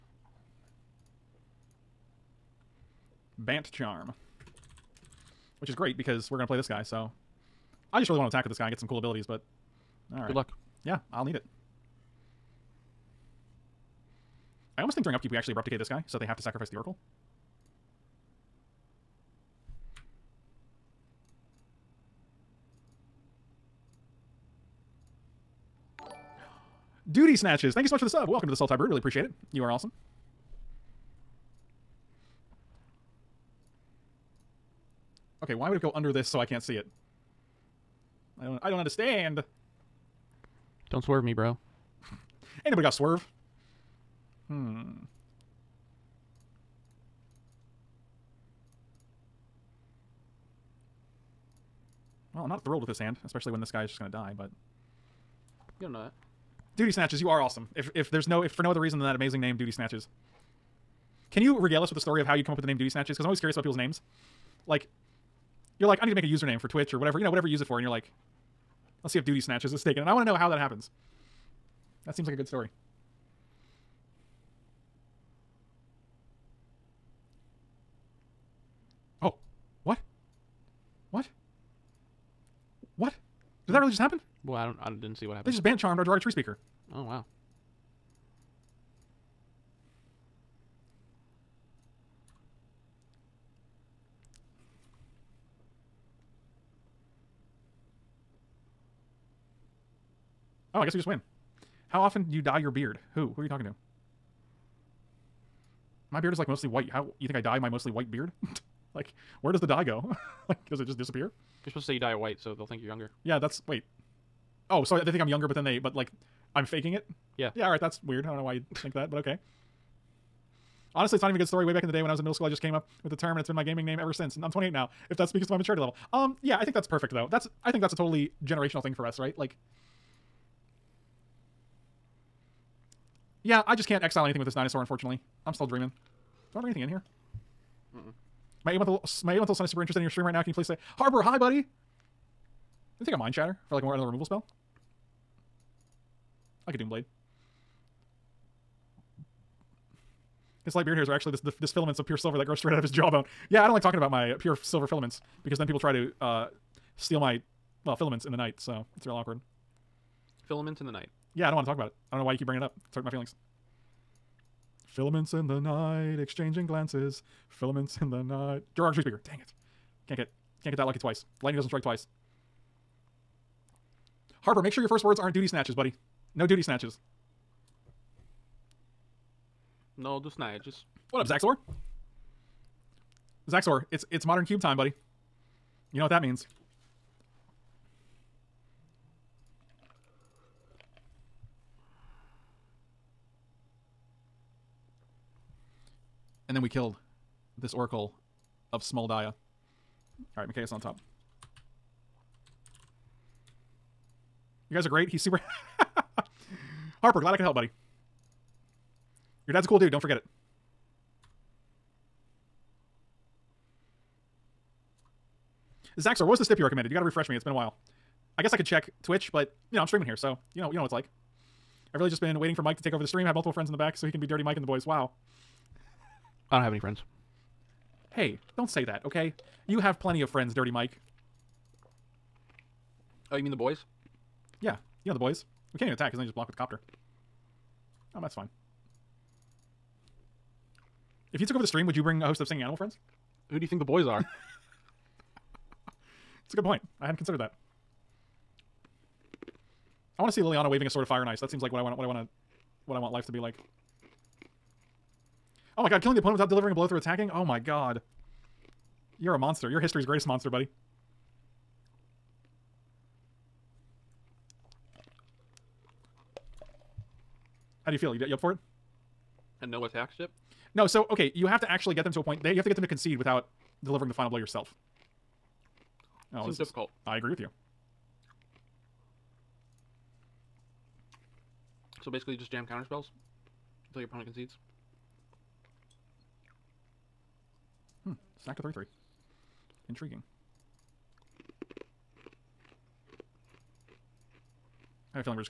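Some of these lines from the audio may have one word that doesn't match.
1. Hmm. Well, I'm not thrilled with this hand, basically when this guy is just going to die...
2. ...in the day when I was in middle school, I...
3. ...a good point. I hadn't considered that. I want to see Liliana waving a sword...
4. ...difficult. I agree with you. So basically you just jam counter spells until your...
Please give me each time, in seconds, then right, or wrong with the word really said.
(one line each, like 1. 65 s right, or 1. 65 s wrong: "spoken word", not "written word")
1. 44 s wrong: "especially", not "basically"
2. 121 s right
3. 246 s right
4. 276 s right.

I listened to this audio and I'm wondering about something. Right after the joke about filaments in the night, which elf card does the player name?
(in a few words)
Joraga Treespeaker.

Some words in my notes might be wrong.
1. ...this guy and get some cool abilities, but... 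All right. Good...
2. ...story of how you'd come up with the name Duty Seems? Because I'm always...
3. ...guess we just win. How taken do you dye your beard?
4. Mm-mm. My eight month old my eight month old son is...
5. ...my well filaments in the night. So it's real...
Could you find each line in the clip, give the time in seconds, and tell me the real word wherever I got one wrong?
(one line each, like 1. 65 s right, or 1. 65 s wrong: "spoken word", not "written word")
1. 8 s right
2. 61 s wrong: "Snatches", not "Seems"
3. 100 s wrong: "often", not "taken"
4. 137 s right
5. 157 s right.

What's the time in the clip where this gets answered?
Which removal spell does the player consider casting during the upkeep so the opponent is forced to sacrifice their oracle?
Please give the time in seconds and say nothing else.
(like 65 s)
15 s.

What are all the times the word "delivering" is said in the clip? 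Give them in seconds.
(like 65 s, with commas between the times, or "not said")
256 s, 273 s.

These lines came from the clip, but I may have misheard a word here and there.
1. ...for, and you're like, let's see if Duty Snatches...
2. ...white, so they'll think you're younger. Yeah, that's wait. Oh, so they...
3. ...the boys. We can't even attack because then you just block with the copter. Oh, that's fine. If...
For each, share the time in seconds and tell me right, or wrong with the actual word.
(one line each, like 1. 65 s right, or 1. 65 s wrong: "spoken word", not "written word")
1. 67 s right
2. 112 s right
3. 235 s right.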